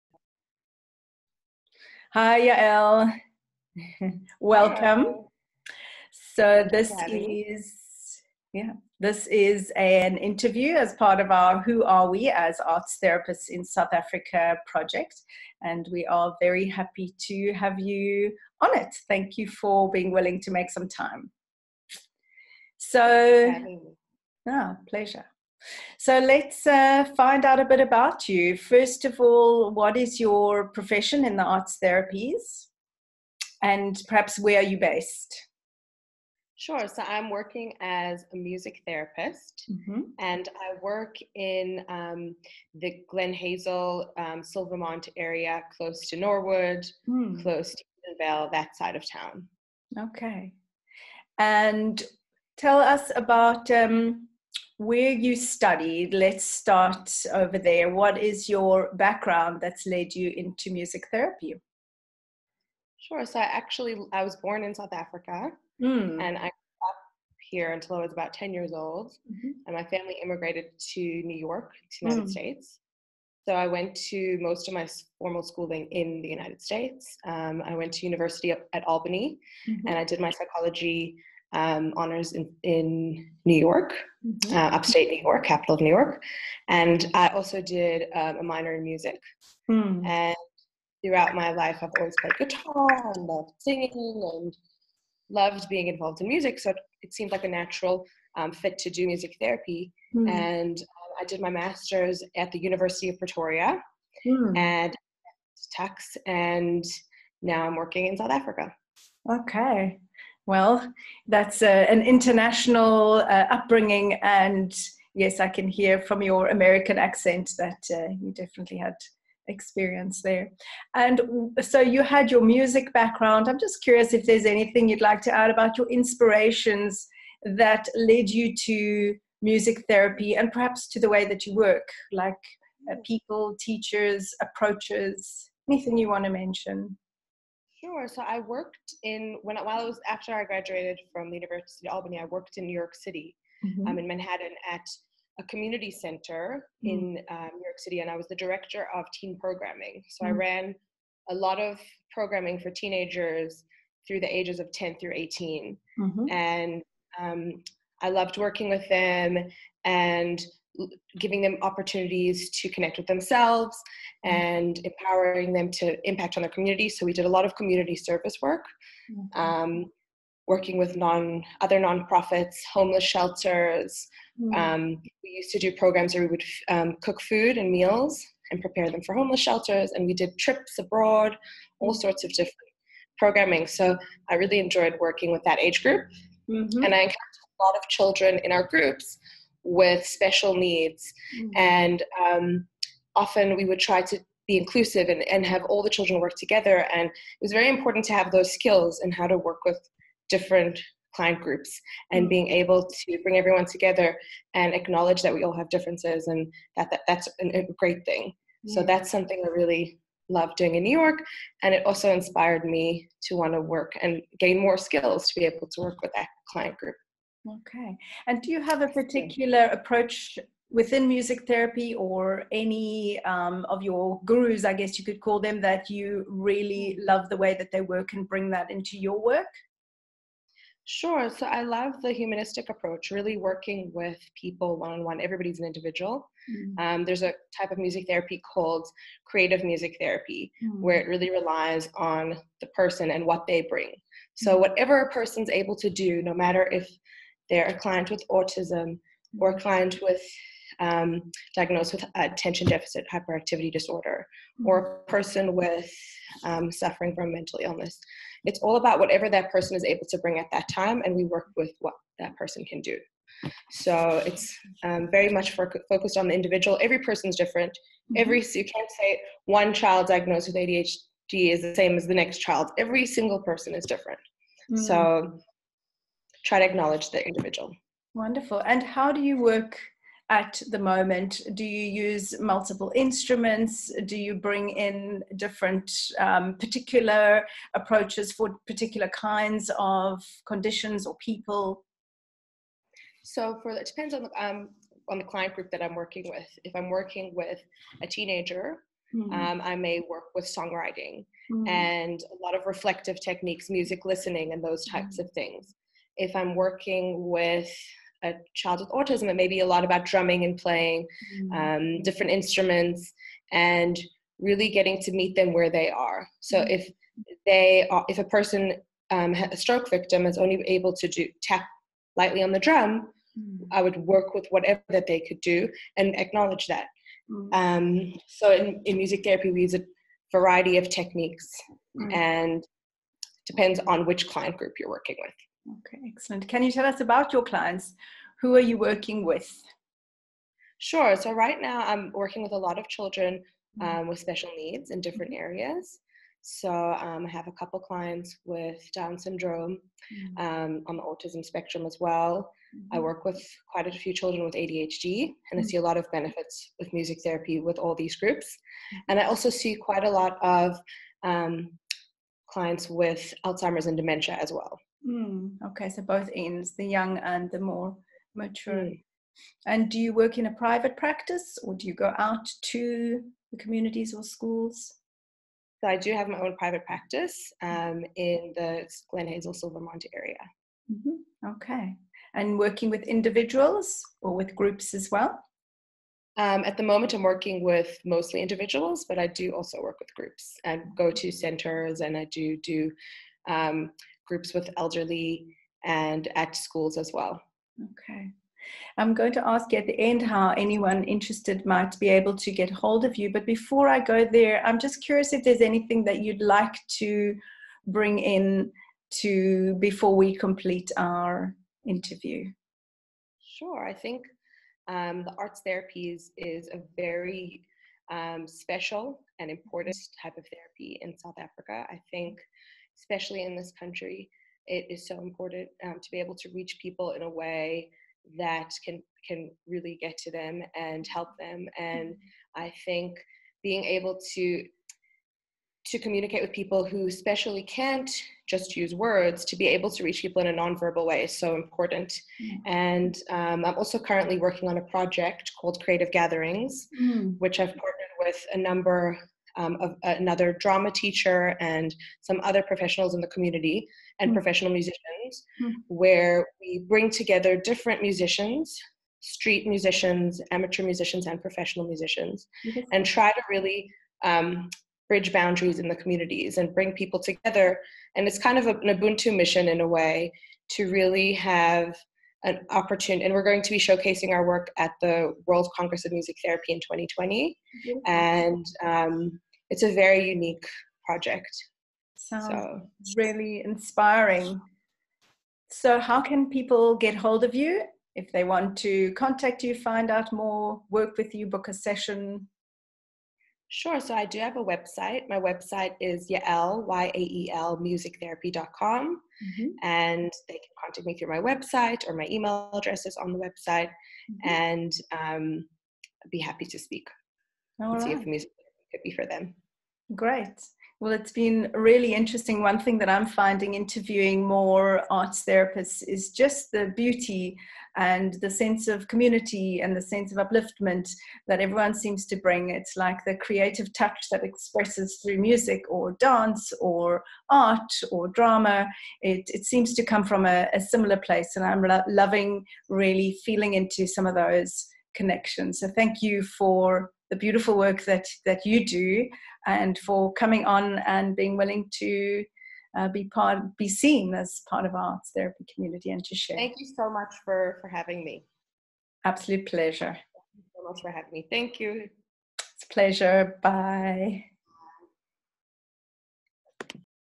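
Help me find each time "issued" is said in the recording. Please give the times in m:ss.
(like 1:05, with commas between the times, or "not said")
not said.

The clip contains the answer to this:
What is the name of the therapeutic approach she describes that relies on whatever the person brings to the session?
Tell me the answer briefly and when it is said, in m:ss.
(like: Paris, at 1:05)
Creative music therapy, at 3:59.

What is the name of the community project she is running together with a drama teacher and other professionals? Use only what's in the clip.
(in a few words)
Creative Gatherings.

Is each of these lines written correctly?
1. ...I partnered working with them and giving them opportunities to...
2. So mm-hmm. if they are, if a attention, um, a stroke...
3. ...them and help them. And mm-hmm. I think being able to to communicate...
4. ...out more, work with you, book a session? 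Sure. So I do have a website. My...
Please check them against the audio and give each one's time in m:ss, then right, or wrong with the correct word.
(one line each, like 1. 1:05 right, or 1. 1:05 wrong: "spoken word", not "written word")
1. 2:38 wrong: "loved", not "partnered"
2. 5:16 wrong: "person", not "attention"
3. 7:10 right
4. 8:10 right.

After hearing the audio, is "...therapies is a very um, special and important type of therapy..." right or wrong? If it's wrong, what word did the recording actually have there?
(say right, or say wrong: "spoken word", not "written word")
right.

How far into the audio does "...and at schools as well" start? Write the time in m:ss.
6:35.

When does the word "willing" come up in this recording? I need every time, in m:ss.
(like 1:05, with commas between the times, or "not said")
0:20, 9:01.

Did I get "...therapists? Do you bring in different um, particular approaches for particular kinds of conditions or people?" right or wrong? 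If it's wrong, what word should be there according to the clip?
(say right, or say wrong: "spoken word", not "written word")
wrong: "instruments", not "therapists".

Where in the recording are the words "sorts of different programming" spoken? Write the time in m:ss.
3:02.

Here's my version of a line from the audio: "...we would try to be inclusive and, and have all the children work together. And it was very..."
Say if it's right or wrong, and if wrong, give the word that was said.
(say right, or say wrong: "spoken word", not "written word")
right.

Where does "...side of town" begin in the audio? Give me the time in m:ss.
0:48.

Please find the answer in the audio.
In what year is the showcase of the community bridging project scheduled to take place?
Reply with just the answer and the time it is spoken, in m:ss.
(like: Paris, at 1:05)
2020, at 7:56.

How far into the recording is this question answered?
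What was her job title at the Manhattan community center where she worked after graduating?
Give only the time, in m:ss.
2:28.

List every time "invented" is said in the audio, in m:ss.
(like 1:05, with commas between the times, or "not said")
not said.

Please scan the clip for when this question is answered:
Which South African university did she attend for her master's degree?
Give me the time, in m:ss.
1:42.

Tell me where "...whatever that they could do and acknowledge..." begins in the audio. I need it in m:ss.
5:24.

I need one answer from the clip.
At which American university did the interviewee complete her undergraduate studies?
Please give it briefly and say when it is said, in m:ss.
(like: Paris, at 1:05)
University at Albany, at 1:18.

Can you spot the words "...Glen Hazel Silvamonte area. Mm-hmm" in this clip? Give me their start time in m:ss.
6:19.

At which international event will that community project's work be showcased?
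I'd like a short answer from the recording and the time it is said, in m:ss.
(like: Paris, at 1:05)
World Congress of Music Therapy, at 7:55.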